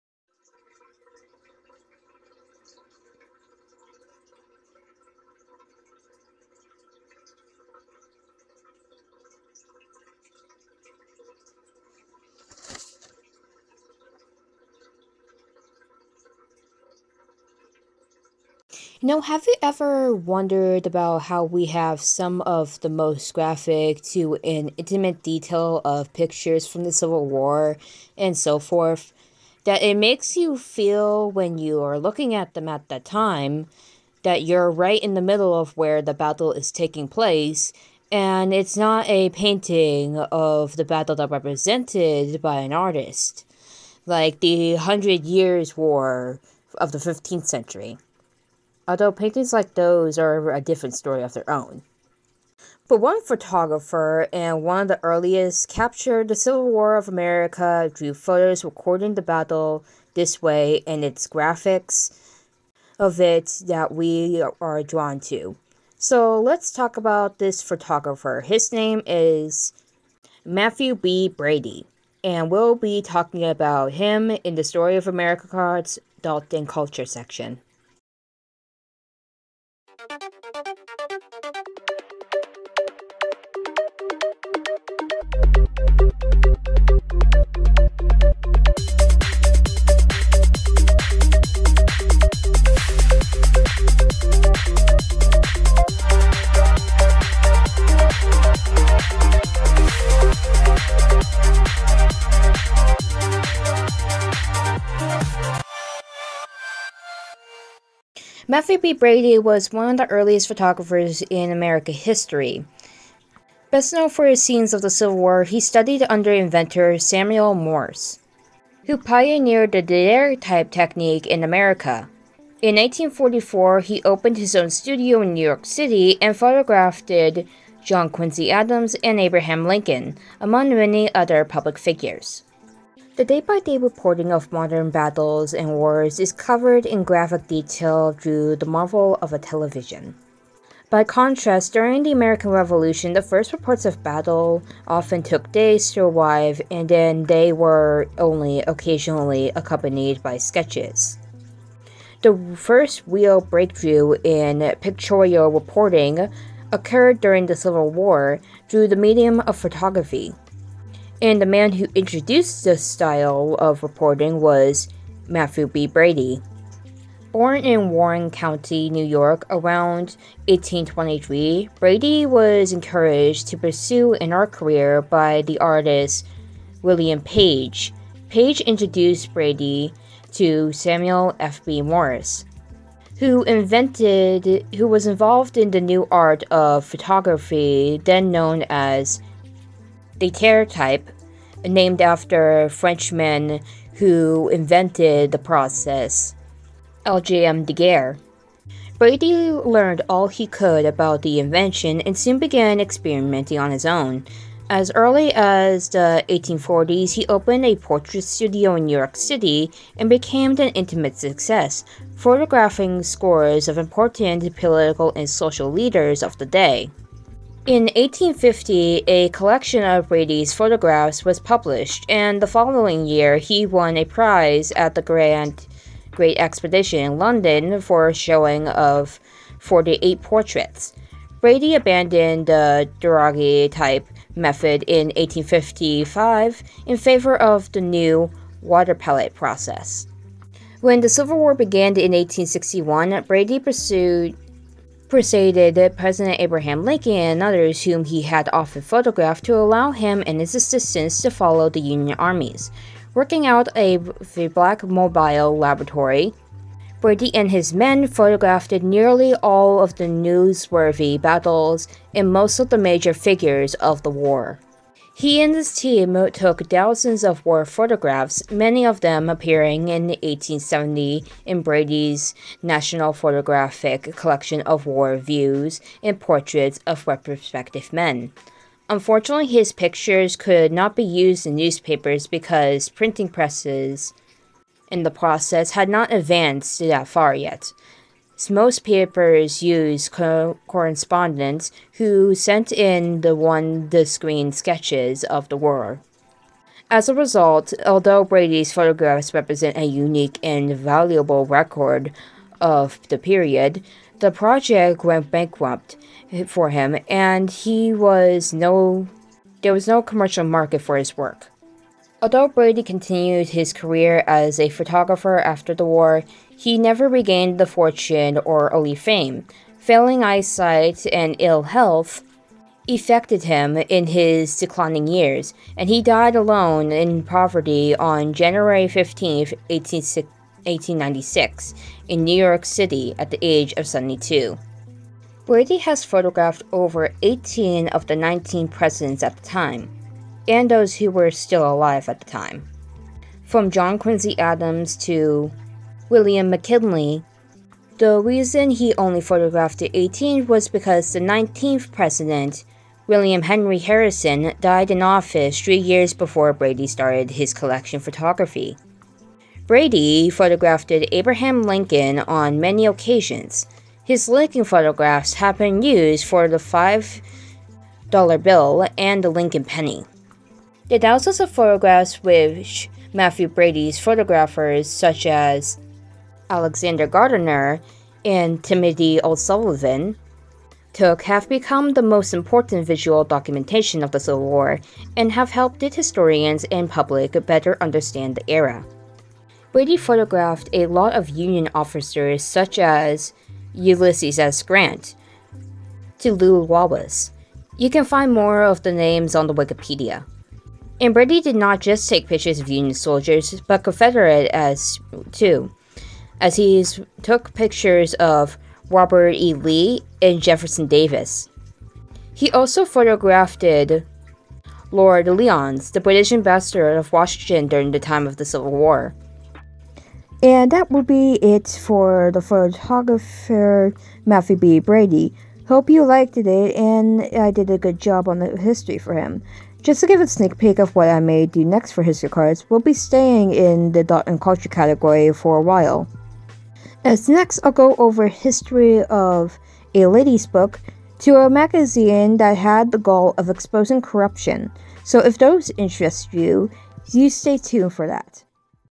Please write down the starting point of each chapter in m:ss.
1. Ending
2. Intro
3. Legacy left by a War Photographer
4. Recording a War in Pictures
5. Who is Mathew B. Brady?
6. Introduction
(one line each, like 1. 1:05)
1. 7:01
2. 1:18
3. 5:36
4. 2:13
5. 1:49
6. 0:18.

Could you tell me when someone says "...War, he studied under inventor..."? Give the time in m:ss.
1:55.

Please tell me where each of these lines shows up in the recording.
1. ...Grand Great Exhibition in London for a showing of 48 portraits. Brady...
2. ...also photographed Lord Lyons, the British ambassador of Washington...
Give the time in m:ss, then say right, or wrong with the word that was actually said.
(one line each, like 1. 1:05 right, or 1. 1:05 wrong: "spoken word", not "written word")
1. 3:45 right
2. 6:52 right.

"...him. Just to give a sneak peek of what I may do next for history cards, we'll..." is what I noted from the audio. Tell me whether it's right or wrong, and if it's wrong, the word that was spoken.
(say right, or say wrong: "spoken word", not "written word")
right.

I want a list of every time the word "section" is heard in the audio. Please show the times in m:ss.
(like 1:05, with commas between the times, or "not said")
1:17.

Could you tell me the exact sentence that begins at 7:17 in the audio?
As next, I'll go over history of a lady's book to a magazine that had the goal of exposing corruption.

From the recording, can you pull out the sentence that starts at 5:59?
Brady photographed Abraham Lincoln on many occasions.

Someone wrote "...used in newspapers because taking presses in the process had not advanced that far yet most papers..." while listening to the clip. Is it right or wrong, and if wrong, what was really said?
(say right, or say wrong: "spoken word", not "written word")
wrong: "printing", not "taking".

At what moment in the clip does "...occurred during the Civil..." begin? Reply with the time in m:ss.
2:36.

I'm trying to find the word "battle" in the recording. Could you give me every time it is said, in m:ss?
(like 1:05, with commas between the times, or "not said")
0:36, 0:40, 0:59, 2:14, 2:24, 4:21.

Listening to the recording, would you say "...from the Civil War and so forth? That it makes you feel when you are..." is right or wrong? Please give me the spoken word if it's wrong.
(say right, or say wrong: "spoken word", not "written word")
right.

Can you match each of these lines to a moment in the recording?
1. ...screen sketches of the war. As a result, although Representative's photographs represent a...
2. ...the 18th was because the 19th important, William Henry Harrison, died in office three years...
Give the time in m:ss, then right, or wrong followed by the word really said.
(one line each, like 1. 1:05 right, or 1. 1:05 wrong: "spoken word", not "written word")
1. 4:54 wrong: "Brady", not "Representative"
2. 5:49 wrong: "president", not "important".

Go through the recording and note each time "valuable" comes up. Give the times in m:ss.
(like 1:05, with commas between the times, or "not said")
5:00.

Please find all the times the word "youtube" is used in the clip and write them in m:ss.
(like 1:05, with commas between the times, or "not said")
not said.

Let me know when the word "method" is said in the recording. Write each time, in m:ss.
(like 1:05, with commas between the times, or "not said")
3:54.